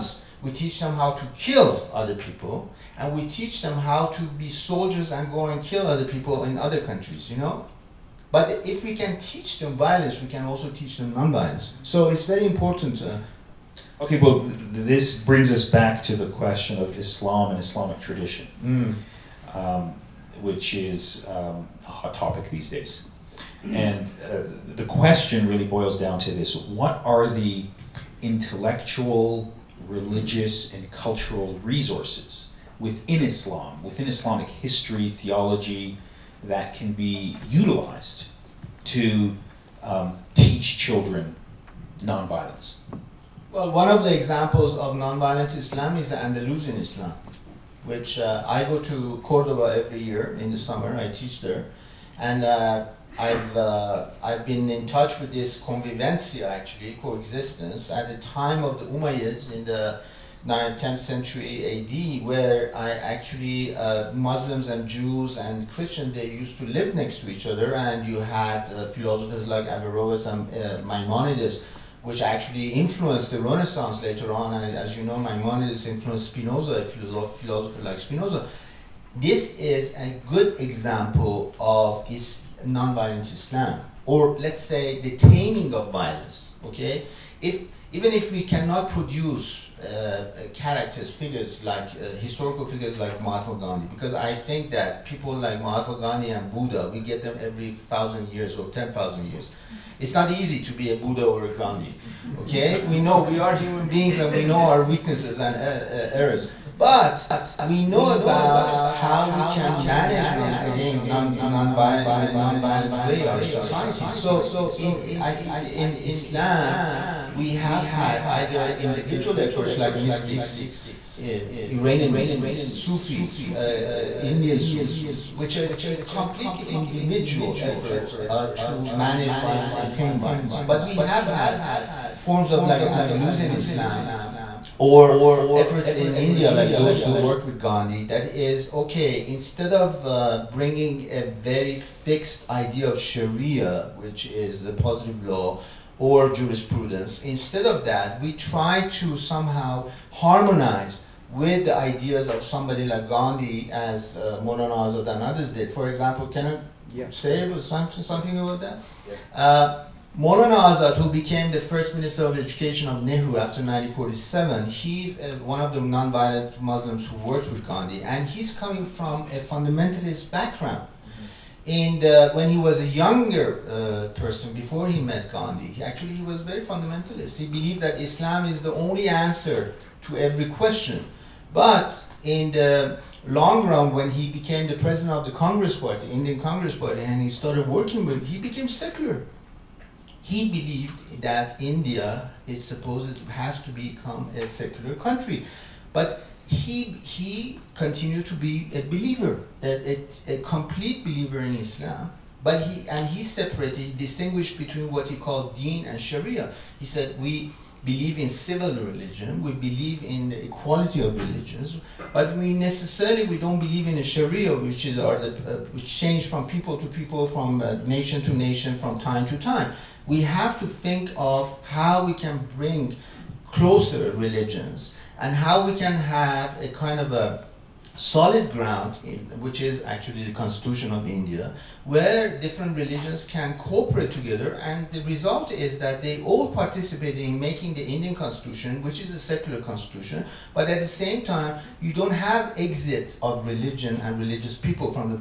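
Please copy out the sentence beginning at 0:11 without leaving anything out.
So it's very important uh, Okay, well, th- this brings us back to the question of Islam and Islamic tradition, mm.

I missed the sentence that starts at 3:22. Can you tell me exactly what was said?
But he and he separated, distinguished between what he called Deen and Sharia.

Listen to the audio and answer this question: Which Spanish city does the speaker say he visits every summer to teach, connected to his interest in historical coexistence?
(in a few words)
Cordoba.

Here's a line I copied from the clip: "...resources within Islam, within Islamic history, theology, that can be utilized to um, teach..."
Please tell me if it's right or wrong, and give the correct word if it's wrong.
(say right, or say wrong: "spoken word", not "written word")
right.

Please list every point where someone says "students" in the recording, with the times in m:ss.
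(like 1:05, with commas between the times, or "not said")
not said.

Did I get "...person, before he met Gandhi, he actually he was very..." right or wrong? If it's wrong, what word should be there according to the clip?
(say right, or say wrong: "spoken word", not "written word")
right.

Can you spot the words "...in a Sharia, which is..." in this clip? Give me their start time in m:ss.
3:33.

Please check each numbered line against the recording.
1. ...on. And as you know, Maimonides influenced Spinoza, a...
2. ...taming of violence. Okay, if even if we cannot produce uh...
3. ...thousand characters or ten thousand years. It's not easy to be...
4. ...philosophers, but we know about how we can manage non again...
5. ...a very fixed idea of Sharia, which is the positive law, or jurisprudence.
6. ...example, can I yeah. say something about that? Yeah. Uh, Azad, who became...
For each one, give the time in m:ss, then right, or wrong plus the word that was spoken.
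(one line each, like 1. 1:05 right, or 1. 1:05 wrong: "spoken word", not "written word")
1. 1:14 right
2. 1:25 right
3. 1:37 wrong: "years", not "characters"
4. 1:45 wrong: "errors", not "philosophers"
5. 2:21 right
6. 2:35 right.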